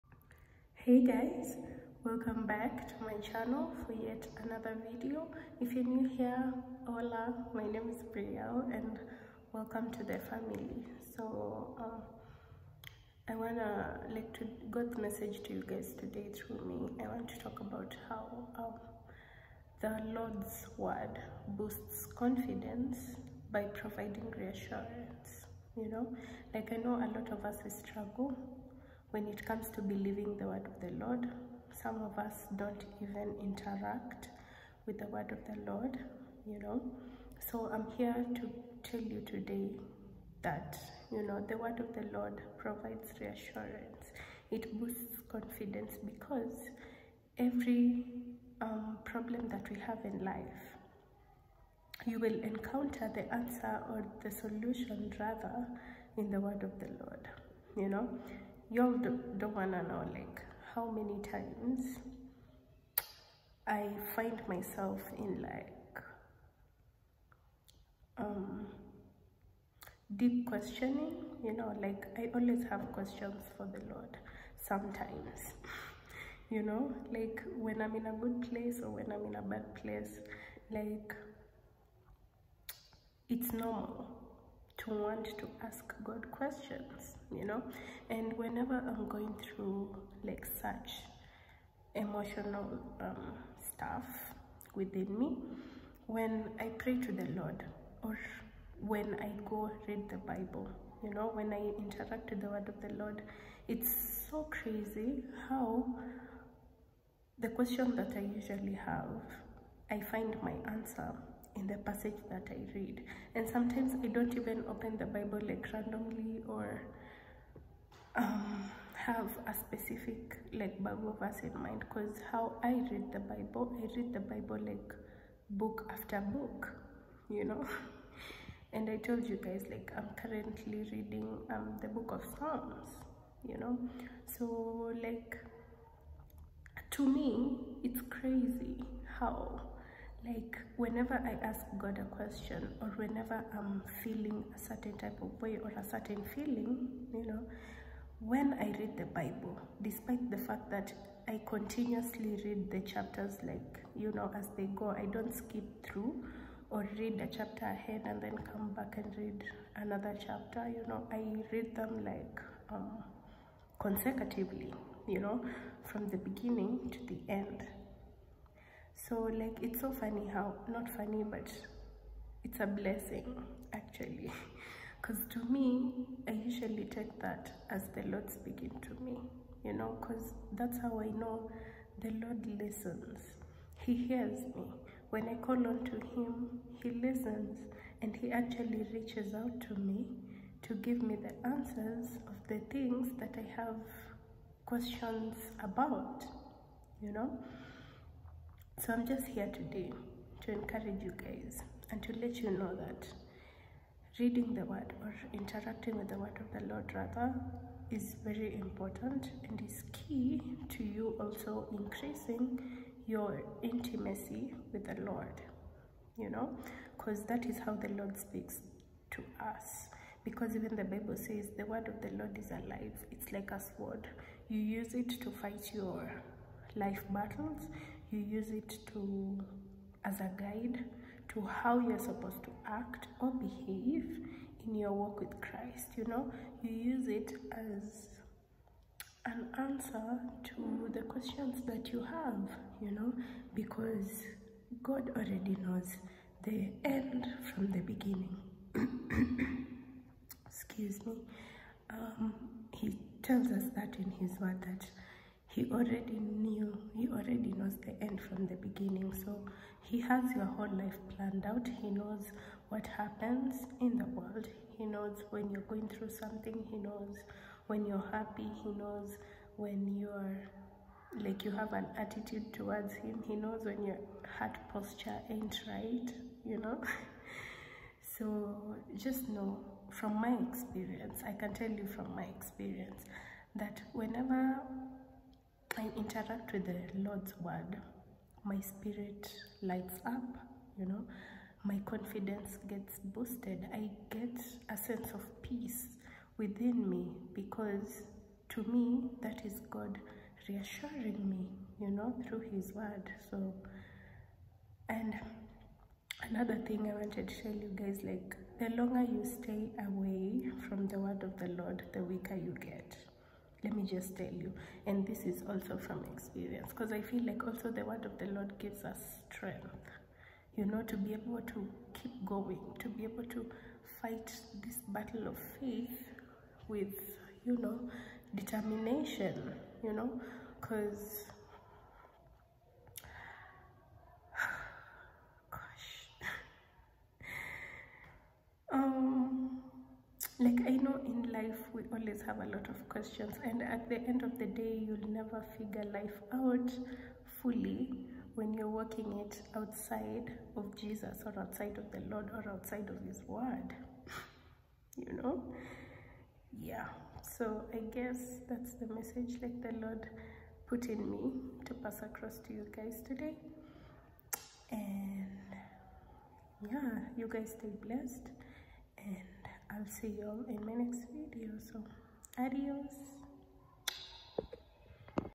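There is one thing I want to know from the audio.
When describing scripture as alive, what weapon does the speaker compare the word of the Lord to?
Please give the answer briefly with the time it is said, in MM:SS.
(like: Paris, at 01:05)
a sword, at 03:43.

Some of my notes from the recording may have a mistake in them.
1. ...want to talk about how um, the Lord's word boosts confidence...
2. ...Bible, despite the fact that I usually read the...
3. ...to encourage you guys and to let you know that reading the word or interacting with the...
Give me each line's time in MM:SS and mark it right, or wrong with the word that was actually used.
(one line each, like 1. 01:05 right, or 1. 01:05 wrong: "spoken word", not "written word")
1. 00:17 right
2. 02:29 wrong: "continuously", not "usually"
3. 03:20 right.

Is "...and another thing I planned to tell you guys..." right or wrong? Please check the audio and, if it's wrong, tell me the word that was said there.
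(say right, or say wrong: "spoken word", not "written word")
wrong: "wanted", not "planned".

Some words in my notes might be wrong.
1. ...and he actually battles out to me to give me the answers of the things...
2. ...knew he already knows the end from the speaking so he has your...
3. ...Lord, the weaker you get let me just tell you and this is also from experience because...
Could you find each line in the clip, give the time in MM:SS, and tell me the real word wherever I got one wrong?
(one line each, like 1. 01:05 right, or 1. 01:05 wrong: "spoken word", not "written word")
1. 03:08 wrong: "reaches", not "battles"
2. 04:16 wrong: "beginning", not "speaking"
3. 05:11 right.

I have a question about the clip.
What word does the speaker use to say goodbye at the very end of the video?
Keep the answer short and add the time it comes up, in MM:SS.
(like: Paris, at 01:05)
adios, at 06:12.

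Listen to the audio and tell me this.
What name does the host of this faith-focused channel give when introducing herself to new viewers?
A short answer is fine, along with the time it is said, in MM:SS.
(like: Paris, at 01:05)
Brielle, at 00:08.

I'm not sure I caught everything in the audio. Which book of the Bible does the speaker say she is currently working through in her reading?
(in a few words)
Psalms.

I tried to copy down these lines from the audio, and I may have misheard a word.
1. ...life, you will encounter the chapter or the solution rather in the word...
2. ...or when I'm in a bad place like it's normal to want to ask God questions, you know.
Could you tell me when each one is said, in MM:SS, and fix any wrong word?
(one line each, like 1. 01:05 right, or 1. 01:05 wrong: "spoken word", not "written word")
1. 00:50 wrong: "answer", not "chapter"
2. 01:18 right.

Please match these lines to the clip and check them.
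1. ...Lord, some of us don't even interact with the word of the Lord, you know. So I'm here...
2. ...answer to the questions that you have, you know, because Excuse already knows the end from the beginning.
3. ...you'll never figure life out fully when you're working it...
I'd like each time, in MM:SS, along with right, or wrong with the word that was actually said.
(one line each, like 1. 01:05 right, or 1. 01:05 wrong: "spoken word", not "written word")
1. 00:31 right
2. 03:59 wrong: "God", not "Excuse"
3. 05:44 right.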